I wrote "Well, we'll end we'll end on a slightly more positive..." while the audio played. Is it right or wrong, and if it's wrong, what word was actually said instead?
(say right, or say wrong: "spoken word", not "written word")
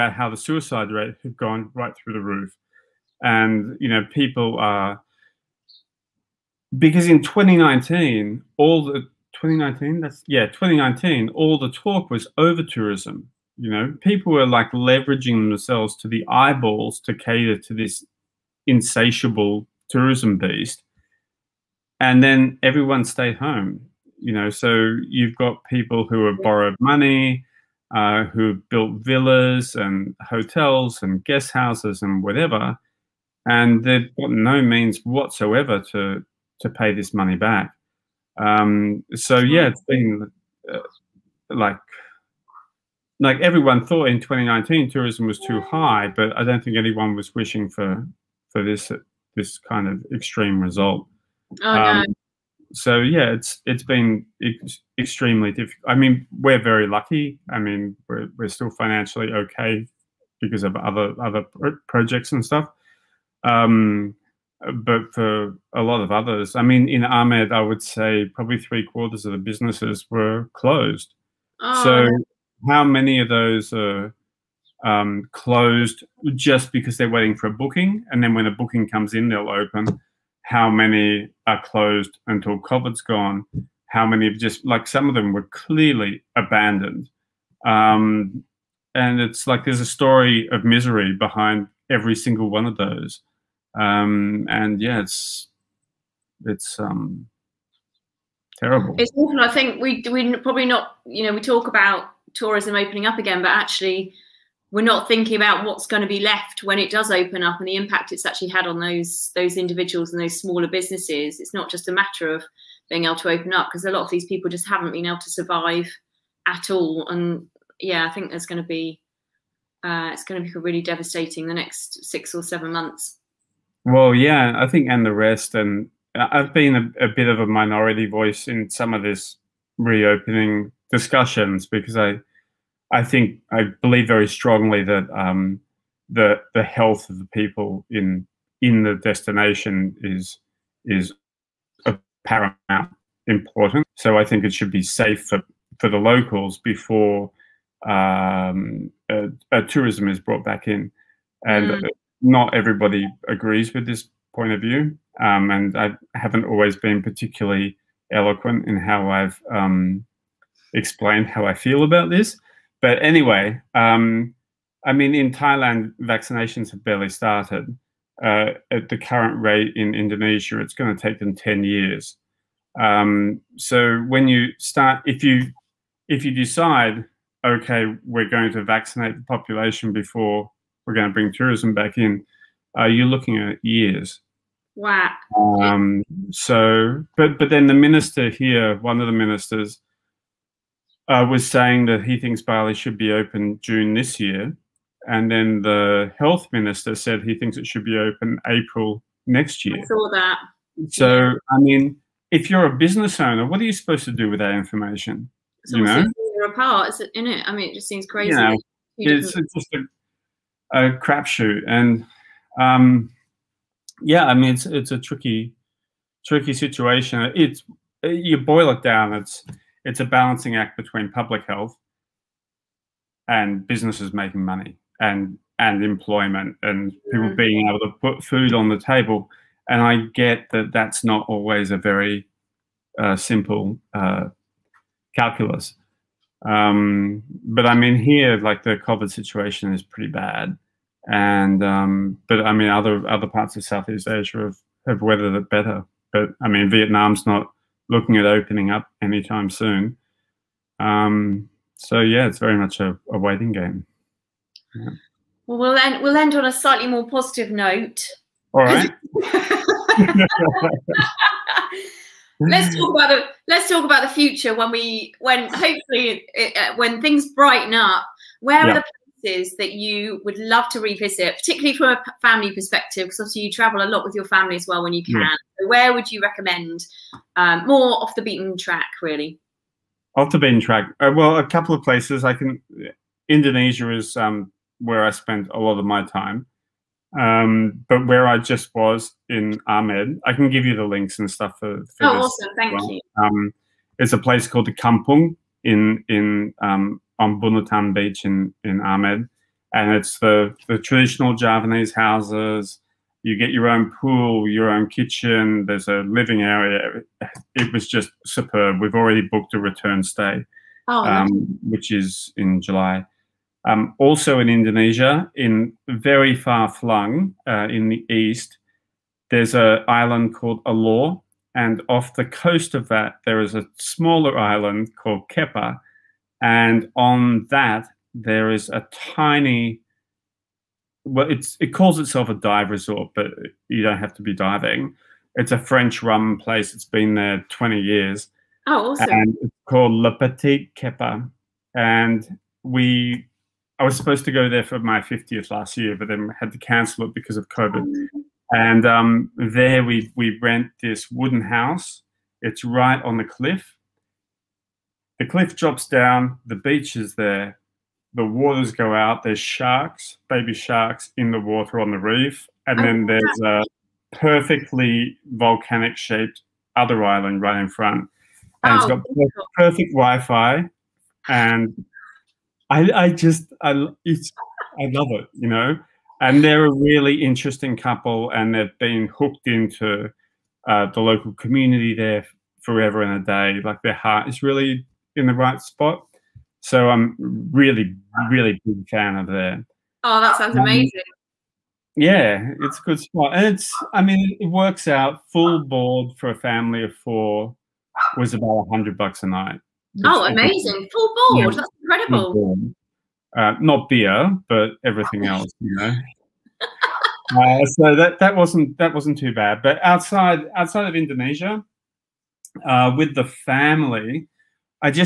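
right.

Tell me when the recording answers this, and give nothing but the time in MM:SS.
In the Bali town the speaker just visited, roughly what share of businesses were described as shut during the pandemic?
01:08.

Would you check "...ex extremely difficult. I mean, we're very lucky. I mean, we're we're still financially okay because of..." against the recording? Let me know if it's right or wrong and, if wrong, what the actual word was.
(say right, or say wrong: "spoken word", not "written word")
right.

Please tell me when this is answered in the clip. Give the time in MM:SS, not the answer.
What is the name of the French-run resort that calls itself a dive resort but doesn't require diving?
05:39.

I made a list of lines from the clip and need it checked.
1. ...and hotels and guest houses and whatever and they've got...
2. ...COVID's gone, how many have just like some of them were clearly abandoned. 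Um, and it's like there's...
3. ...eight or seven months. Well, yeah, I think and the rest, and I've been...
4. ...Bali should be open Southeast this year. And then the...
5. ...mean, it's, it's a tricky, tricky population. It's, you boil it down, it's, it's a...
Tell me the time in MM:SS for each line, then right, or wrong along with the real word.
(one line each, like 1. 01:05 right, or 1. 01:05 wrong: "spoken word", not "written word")
1. 00:29 right
2. 01:22 right
3. 02:02 wrong: "six", not "eight"
4. 03:12 wrong: "June", not "Southeast"
5. 03:34 wrong: "situation", not "population".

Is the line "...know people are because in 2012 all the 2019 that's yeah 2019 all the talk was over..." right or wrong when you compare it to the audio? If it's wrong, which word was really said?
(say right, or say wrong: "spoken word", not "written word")
wrong: "2019", not "2012".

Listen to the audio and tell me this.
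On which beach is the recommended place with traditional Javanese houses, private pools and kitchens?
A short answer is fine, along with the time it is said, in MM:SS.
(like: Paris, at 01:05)
Bunutan Beach, at 04:57.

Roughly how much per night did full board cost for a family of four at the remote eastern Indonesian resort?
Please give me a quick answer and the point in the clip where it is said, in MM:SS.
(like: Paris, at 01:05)
100 bucks, at 06:38.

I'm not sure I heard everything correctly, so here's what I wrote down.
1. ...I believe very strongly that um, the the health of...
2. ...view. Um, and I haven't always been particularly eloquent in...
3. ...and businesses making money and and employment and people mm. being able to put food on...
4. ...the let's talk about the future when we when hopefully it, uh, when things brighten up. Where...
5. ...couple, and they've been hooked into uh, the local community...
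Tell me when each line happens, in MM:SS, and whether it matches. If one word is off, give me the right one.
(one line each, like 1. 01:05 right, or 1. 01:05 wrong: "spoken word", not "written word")
1. 02:13 right
2. 02:34 right
3. 03:43 right
4. 04:23 right
5. 06:17 right.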